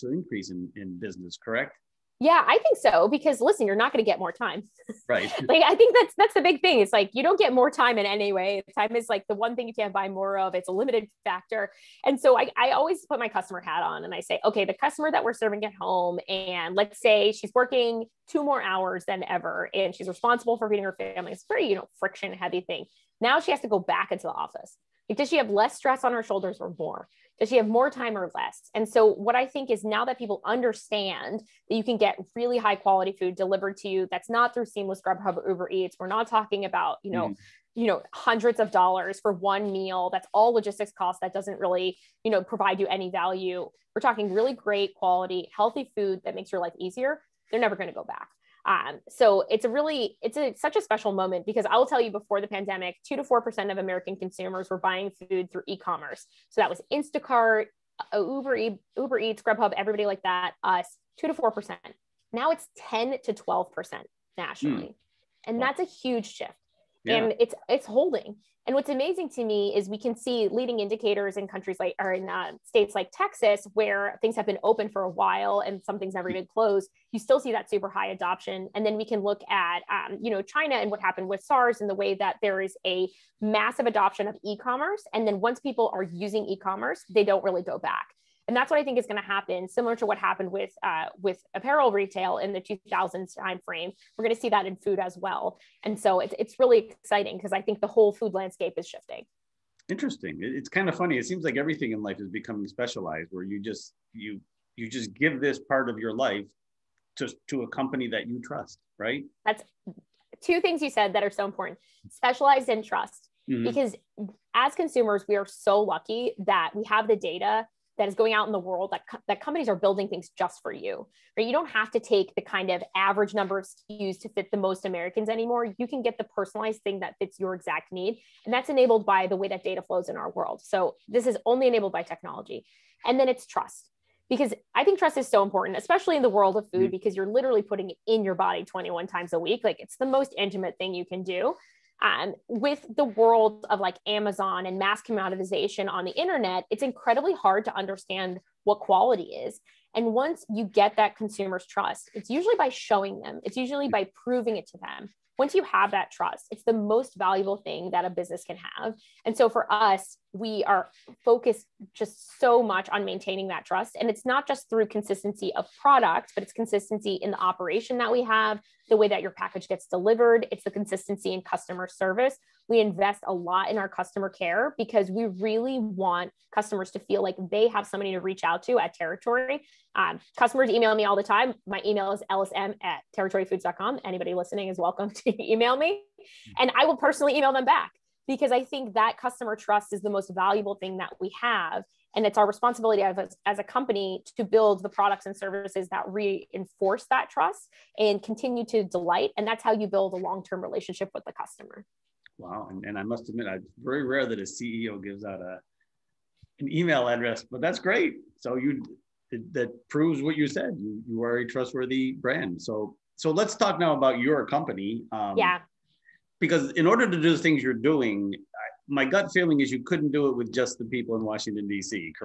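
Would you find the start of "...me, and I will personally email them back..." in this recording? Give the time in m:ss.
3:05.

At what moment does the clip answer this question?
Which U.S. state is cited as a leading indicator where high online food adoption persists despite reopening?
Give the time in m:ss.
1:13.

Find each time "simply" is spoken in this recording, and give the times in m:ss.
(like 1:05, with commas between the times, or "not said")
not said.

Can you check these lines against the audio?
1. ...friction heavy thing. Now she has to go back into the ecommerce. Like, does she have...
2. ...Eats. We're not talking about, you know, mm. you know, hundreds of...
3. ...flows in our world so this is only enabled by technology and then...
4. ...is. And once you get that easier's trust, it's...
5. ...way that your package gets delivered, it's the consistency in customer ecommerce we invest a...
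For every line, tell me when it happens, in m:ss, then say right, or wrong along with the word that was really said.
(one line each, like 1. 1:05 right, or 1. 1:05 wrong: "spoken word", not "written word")
1. 0:21 wrong: "office", not "ecommerce"
2. 0:35 right
3. 2:09 right
4. 2:29 wrong: "consumer", not "easier"
5. 2:48 wrong: "service", not "ecommerce".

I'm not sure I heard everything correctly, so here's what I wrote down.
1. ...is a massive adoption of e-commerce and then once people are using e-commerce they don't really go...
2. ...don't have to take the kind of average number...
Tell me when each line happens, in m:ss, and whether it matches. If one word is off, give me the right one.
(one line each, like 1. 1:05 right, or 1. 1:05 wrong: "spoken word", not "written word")
1. 1:22 right
2. 2:01 right.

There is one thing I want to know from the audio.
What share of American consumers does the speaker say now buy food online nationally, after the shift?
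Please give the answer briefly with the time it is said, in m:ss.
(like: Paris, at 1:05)
10 to 12 percent, at 1:02.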